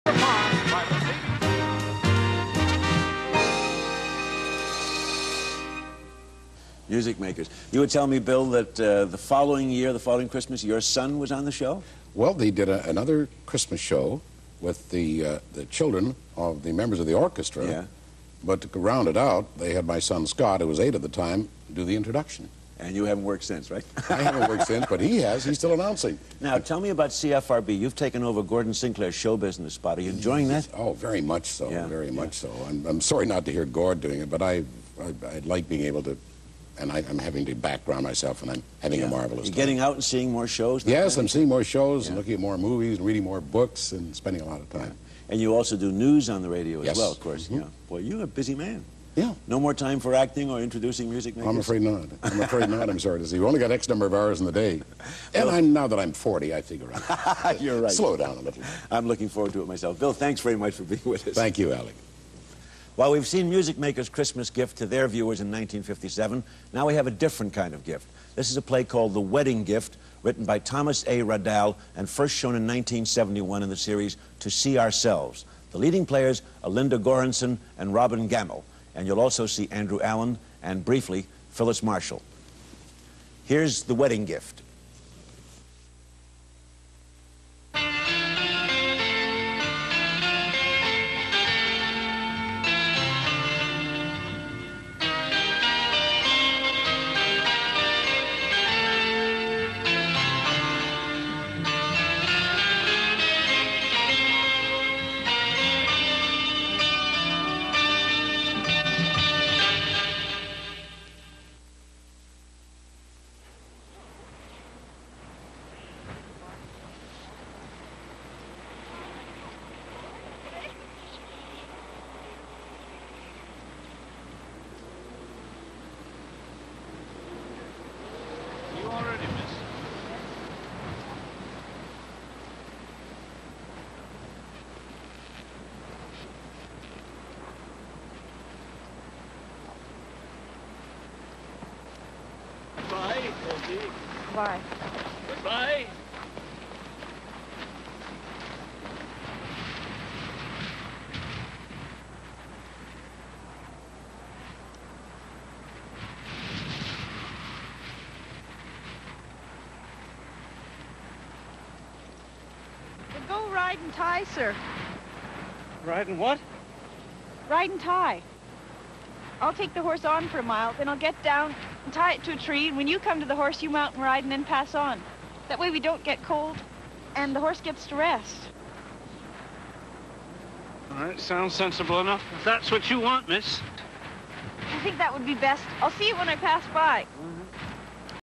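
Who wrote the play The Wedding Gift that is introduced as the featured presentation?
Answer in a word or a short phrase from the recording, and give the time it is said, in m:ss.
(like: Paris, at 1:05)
Thomas A. Raddall, at 1:10.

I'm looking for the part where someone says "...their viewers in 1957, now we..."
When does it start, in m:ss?
1:04.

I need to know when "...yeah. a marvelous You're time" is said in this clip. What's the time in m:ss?
0:38.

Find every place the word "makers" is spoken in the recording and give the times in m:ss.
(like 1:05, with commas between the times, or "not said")
0:07, 0:51, 1:03.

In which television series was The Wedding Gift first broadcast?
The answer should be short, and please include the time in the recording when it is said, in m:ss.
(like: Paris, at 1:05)
To See Ourselves, at 1:14.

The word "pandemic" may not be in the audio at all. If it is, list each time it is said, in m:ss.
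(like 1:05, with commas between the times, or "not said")
not said.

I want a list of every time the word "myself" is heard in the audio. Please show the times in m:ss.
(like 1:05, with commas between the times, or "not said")
0:38, 0:59.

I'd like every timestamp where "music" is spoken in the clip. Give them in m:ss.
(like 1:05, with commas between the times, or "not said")
0:06, 0:51, 1:03.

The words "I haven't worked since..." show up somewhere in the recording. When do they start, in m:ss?
0:24.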